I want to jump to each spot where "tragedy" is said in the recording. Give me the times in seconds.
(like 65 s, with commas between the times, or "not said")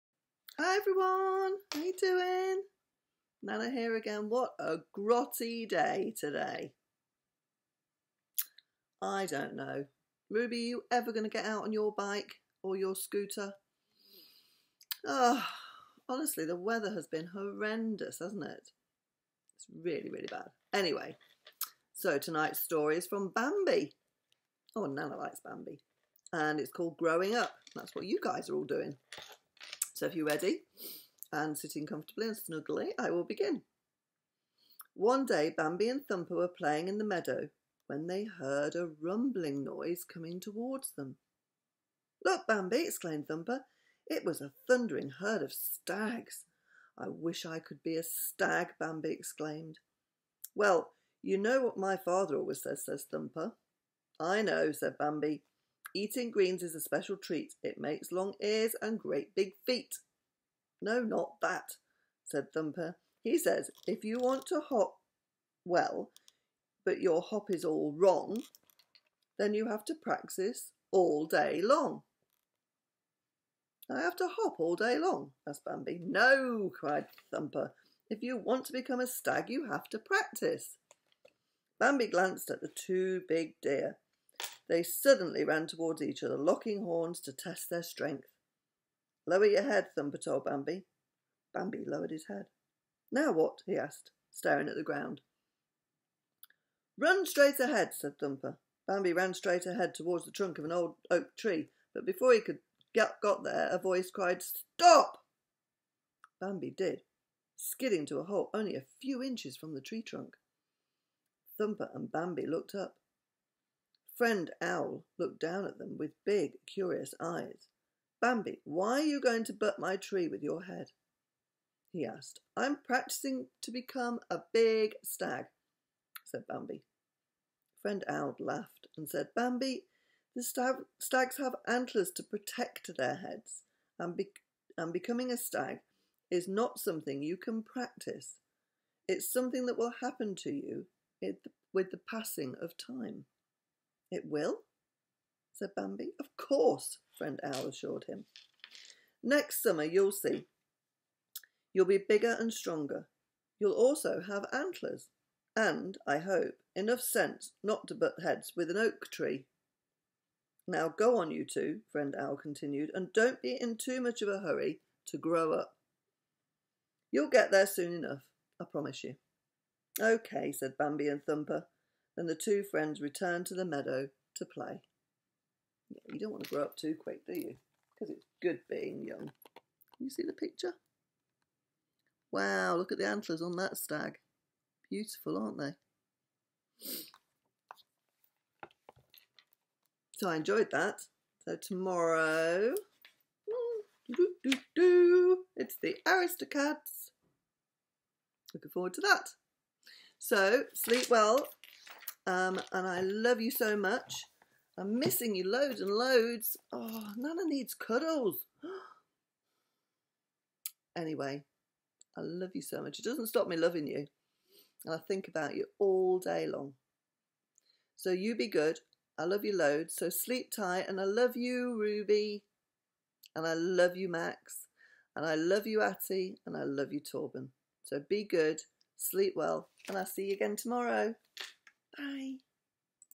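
not said.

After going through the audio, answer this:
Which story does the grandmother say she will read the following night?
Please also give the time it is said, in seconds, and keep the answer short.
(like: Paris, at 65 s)
The Aristocats, at 195 s.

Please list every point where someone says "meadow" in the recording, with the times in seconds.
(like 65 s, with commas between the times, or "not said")
37 s, 173 s.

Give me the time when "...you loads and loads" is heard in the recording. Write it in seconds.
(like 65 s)
205 s.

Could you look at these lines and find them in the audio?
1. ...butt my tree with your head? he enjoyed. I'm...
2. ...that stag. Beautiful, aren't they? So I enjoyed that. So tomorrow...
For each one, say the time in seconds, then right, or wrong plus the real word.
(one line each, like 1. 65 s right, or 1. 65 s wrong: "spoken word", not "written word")
1. 119 s wrong: "asked", not "enjoyed"
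2. 183 s right.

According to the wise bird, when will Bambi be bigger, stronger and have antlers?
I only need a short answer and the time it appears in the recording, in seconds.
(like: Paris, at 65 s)
Next summer, at 149 s.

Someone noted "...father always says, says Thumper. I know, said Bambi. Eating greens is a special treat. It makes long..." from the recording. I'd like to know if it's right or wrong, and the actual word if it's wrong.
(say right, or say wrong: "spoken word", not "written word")
right.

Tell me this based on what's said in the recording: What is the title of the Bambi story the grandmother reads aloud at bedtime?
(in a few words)
Growing Up.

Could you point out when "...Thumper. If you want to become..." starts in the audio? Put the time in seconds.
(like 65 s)
77 s.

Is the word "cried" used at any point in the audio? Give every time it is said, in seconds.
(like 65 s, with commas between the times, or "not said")
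76 s, 104 s.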